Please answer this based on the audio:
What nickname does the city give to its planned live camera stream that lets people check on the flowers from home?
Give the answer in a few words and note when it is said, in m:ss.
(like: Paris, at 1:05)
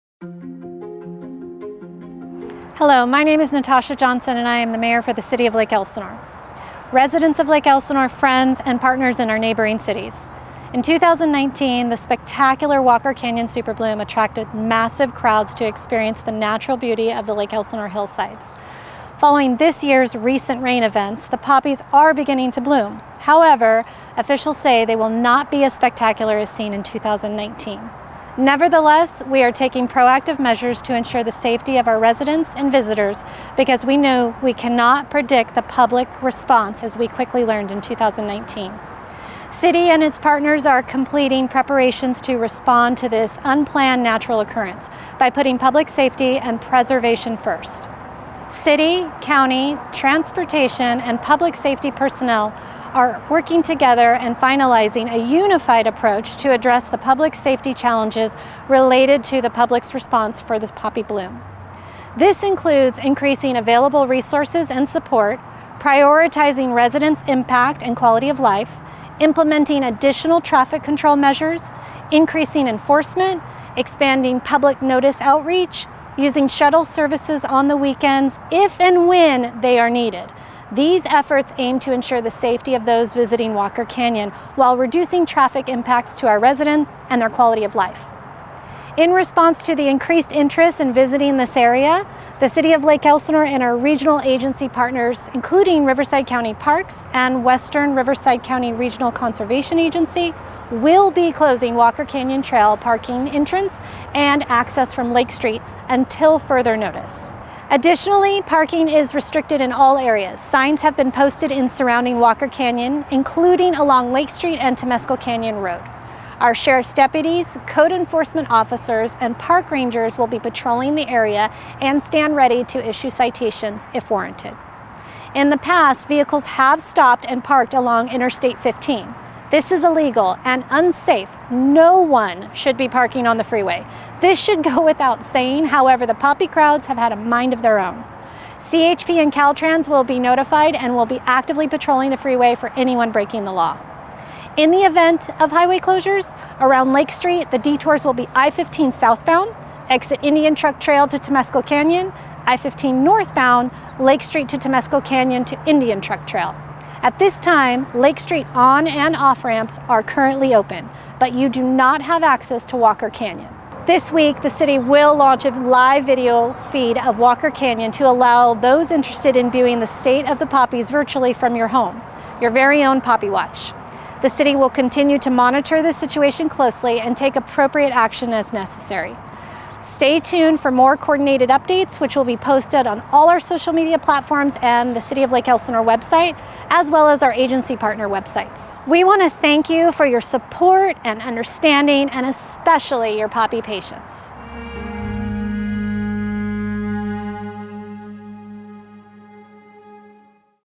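Poppy Watch, at 2:53.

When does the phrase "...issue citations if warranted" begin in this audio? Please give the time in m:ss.
2:02.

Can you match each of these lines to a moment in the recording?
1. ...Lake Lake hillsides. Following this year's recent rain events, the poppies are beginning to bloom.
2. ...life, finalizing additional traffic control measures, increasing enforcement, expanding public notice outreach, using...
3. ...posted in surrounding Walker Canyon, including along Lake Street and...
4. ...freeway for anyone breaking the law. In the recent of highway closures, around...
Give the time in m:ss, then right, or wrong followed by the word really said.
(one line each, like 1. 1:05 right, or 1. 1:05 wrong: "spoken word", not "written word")
1. 0:17 wrong: "Elsinore", not "Lake"
2. 1:08 wrong: "implementing", not "finalizing"
3. 1:51 right
4. 2:22 wrong: "event", not "recent".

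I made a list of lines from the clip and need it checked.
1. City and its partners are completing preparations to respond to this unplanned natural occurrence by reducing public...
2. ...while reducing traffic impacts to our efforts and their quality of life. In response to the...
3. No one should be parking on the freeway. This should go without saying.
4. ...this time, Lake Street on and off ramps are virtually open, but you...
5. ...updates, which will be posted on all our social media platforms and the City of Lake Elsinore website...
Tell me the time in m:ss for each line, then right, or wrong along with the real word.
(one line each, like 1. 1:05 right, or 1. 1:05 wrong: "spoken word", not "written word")
1. 0:39 wrong: "putting", not "reducing"
2. 1:24 wrong: "residents", not "efforts"
3. 2:11 right
4. 2:37 wrong: "currently", not "virtually"
5. 3:01 right.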